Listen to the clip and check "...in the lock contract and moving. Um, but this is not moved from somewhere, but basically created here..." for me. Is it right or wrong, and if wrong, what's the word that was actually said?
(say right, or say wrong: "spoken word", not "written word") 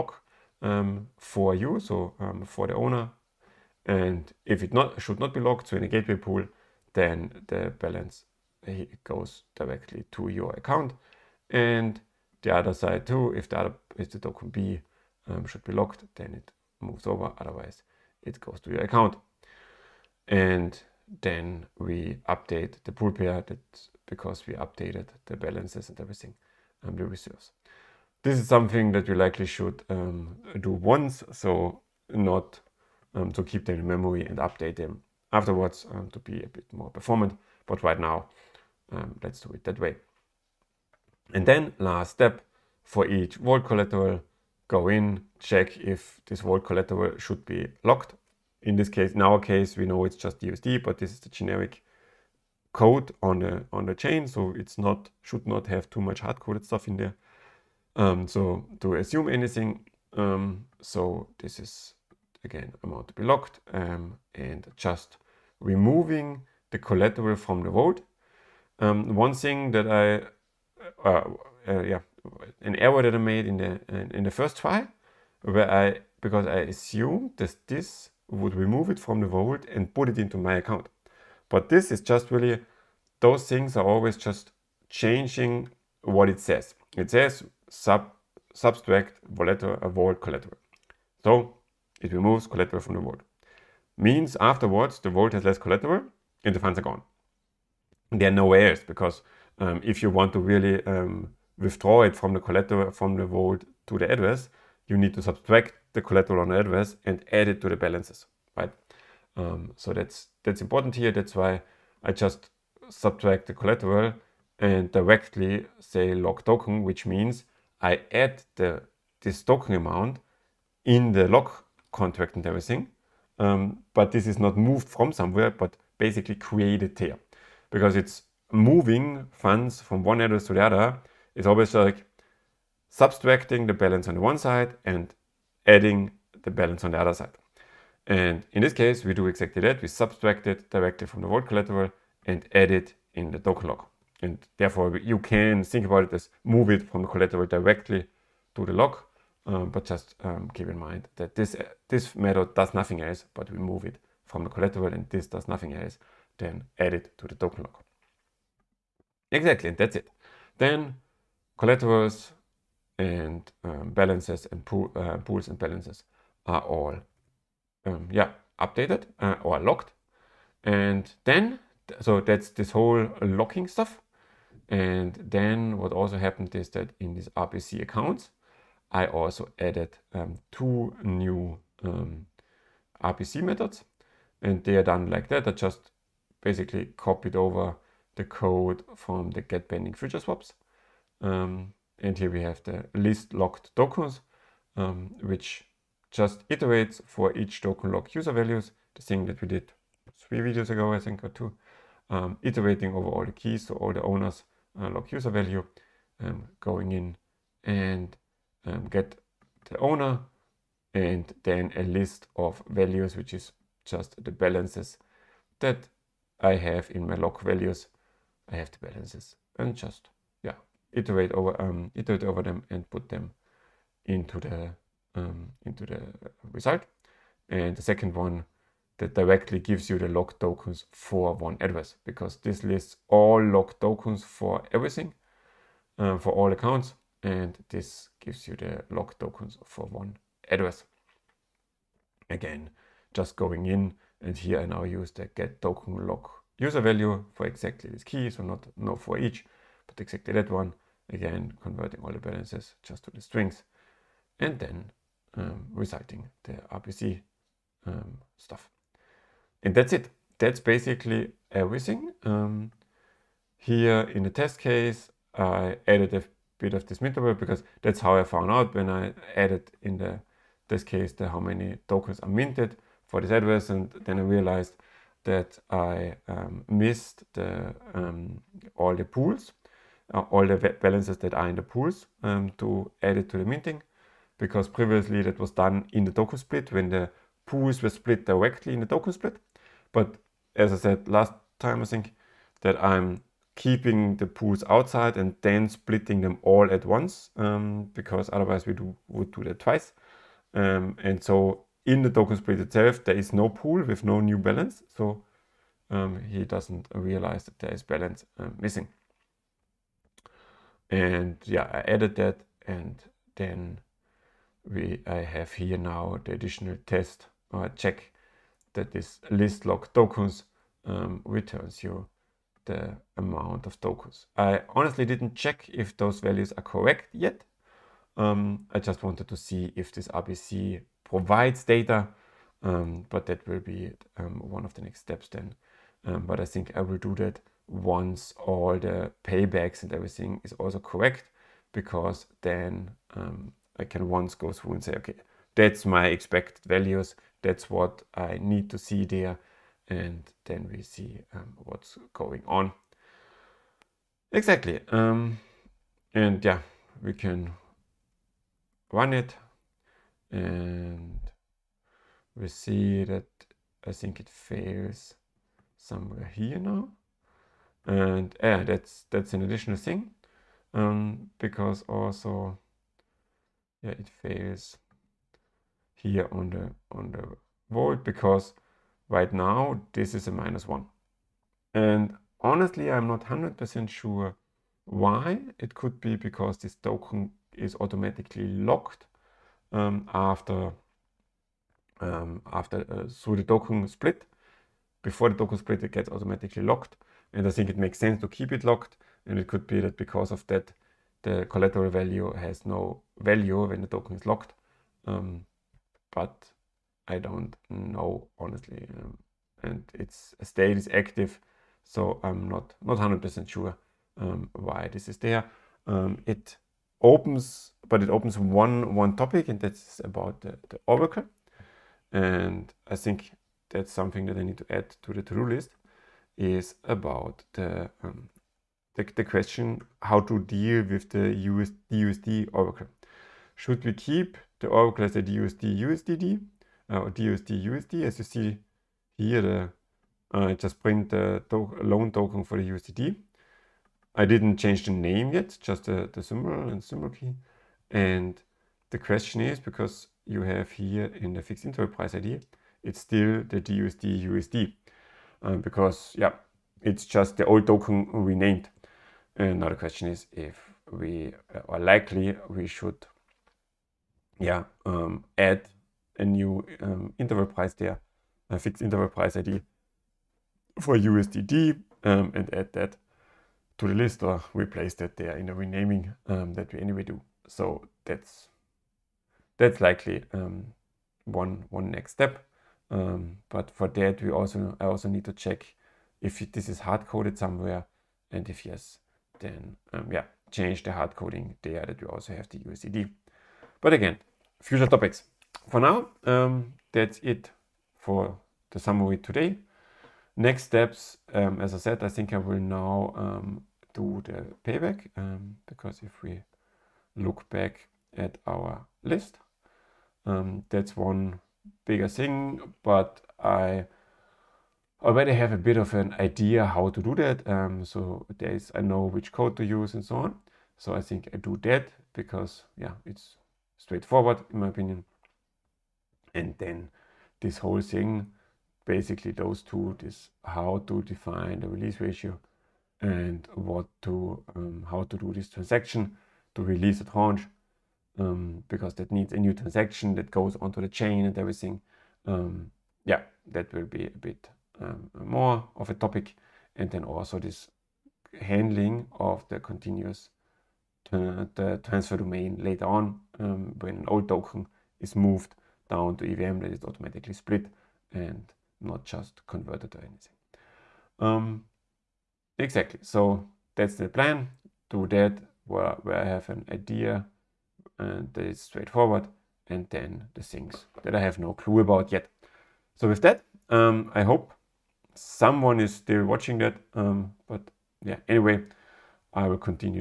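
wrong: "everything", not "moving".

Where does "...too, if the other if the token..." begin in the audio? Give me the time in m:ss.
0:13.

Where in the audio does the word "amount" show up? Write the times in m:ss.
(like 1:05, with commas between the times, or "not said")
1:02, 1:59, 5:23.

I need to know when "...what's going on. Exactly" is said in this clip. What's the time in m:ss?
5:51.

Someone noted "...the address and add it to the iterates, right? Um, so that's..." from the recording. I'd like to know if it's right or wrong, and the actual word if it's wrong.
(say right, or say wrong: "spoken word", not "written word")
wrong: "balances", not "iterates".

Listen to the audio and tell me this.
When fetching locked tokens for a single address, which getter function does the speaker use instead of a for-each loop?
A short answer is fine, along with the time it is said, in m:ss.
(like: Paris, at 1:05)
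get token lock user value, at 4:05.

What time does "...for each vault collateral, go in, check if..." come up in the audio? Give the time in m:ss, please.
0:42.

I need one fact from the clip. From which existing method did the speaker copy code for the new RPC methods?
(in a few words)
get pending future swaps.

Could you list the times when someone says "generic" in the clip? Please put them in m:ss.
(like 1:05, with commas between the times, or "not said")
0:51.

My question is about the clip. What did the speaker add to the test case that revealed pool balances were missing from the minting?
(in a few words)
mintable.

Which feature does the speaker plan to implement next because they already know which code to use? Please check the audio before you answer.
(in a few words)
payback.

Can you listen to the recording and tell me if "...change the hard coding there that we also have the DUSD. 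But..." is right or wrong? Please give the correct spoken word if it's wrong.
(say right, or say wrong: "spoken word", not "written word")
wrong: "USDD", not "DUSD".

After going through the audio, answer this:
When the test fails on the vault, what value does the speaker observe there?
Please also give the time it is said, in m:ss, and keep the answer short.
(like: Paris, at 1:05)
-1, at 6:20.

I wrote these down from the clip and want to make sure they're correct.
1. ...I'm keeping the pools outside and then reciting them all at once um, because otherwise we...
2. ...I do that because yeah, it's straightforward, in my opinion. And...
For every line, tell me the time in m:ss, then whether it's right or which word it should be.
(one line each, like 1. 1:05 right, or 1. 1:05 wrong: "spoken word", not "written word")
1. 4:52 wrong: "splitting", not "reciting"
2. 8:41 right.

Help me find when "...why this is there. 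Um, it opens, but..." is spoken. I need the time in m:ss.
6:54.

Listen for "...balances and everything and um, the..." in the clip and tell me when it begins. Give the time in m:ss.
0:25.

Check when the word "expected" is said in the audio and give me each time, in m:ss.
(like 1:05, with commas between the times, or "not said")
5:46.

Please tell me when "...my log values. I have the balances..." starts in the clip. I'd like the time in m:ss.
3:37.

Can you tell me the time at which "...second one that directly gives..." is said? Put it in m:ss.
3:47.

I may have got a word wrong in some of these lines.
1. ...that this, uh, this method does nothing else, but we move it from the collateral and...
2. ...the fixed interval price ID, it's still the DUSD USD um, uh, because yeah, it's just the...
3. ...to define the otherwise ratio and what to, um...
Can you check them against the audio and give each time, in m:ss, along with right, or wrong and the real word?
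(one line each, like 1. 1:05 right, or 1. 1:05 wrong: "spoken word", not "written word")
1. 2:31 right
2. 7:31 right
3. 8:50 wrong: "release", not "otherwise".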